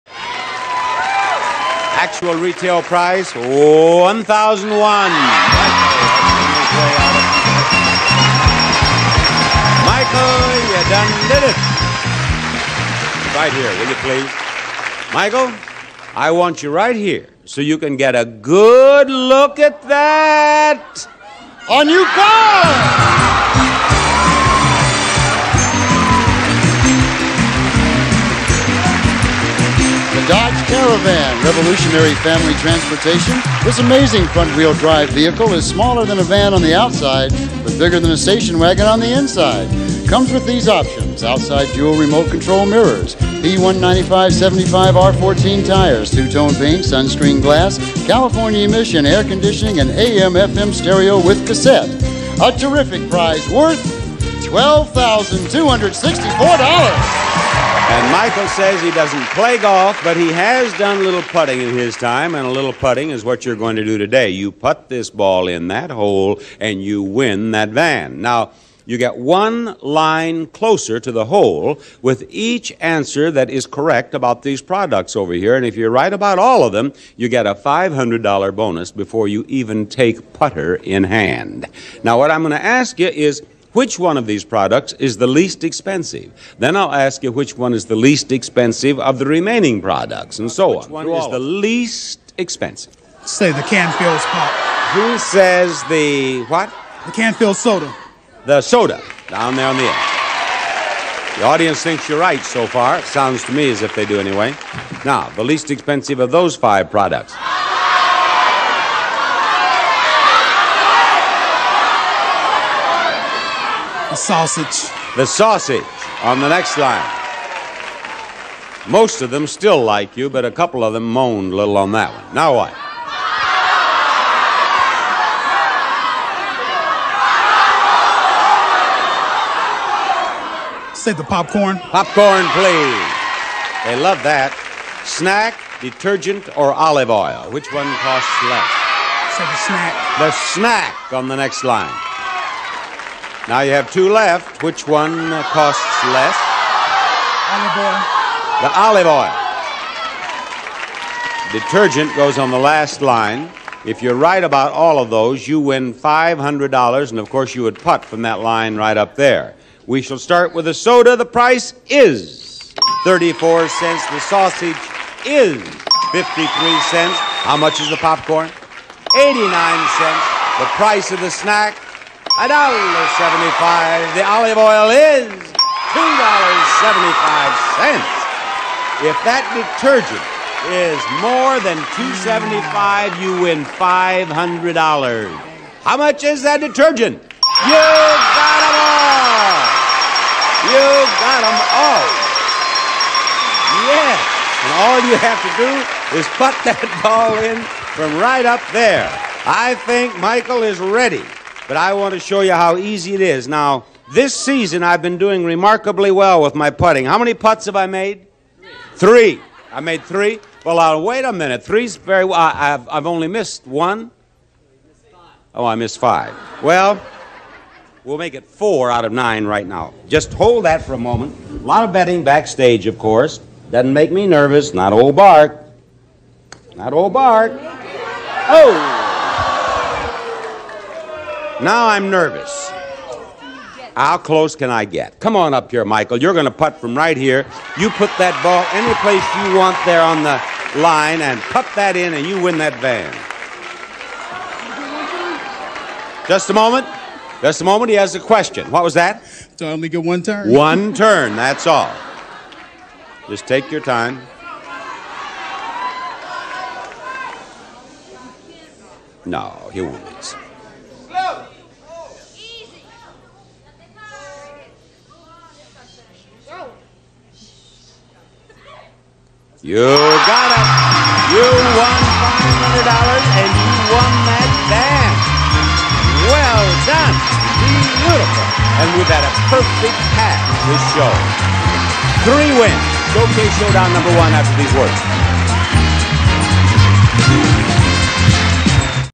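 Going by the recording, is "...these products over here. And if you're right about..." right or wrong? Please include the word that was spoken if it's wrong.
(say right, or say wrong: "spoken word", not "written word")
right.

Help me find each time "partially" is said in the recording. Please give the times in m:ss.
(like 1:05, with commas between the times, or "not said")
not said.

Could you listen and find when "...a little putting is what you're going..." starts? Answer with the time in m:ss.
1:02.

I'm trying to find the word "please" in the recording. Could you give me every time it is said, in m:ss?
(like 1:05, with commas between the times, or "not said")
0:14, 2:12.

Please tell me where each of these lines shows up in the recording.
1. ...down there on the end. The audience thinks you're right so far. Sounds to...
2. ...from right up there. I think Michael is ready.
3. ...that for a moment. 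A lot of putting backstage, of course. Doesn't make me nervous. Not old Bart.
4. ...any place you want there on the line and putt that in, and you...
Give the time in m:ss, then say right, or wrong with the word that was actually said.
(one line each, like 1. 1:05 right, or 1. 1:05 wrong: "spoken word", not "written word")
1. 1:39 right
2. 3:17 right
3. 3:40 wrong: "betting", not "putting"
4. 3:58 right.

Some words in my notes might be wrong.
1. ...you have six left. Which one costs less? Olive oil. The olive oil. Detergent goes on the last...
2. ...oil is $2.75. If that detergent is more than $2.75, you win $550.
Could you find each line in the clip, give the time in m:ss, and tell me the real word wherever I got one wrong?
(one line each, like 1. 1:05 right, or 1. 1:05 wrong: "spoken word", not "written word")
1. 2:23 wrong: "two", not "six"
2. 2:54 wrong: "500", not "550".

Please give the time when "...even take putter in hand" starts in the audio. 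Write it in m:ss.
1:19.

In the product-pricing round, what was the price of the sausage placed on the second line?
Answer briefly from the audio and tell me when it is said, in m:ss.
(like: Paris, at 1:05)
53 cents, at 2:46.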